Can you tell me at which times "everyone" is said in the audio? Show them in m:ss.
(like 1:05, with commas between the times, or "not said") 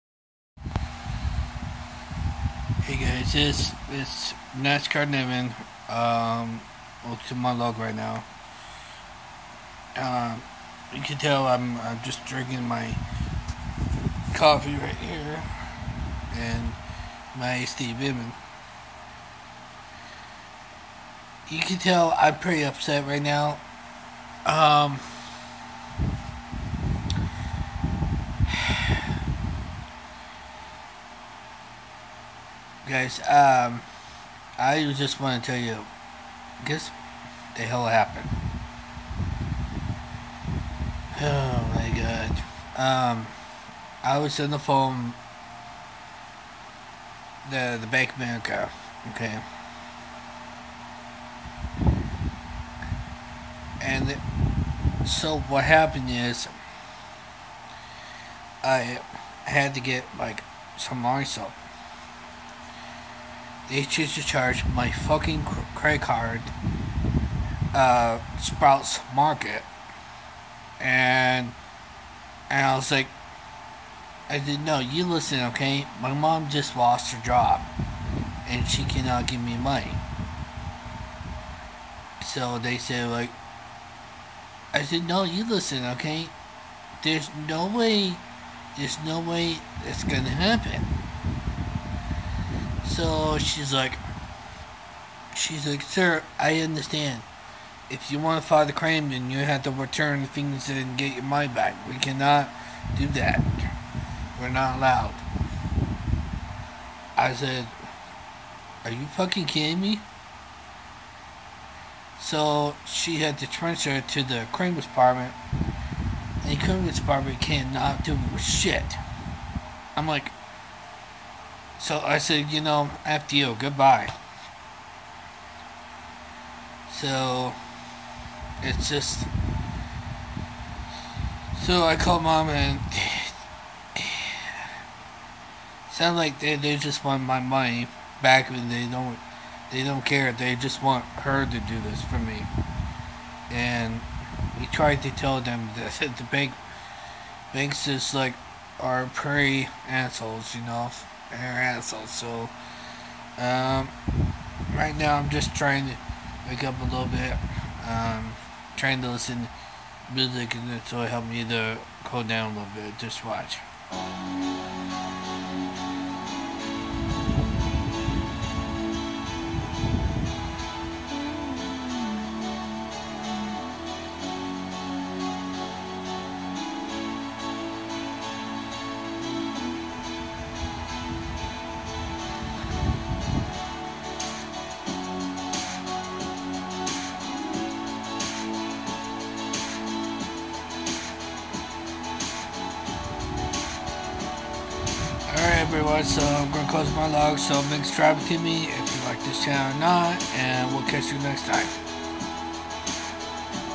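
3:15.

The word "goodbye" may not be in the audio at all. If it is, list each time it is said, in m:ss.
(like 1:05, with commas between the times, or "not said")
2:03.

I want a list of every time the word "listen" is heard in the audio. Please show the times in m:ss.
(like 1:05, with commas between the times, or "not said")
1:15, 1:25, 2:39.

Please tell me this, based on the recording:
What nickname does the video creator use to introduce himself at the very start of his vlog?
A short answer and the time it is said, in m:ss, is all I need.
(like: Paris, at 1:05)
NASCAR Nathan, at 0:04.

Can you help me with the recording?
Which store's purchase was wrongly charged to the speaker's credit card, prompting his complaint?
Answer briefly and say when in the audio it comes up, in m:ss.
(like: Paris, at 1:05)
Sprouts Market, at 1:08.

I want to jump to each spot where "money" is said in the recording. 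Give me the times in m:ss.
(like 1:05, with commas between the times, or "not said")
1:19, 1:41, 2:17.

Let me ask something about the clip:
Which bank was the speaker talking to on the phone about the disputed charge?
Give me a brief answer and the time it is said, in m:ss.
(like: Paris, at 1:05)
Bank of America, at 0:47.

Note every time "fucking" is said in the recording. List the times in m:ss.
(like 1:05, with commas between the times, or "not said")
1:04, 1:49.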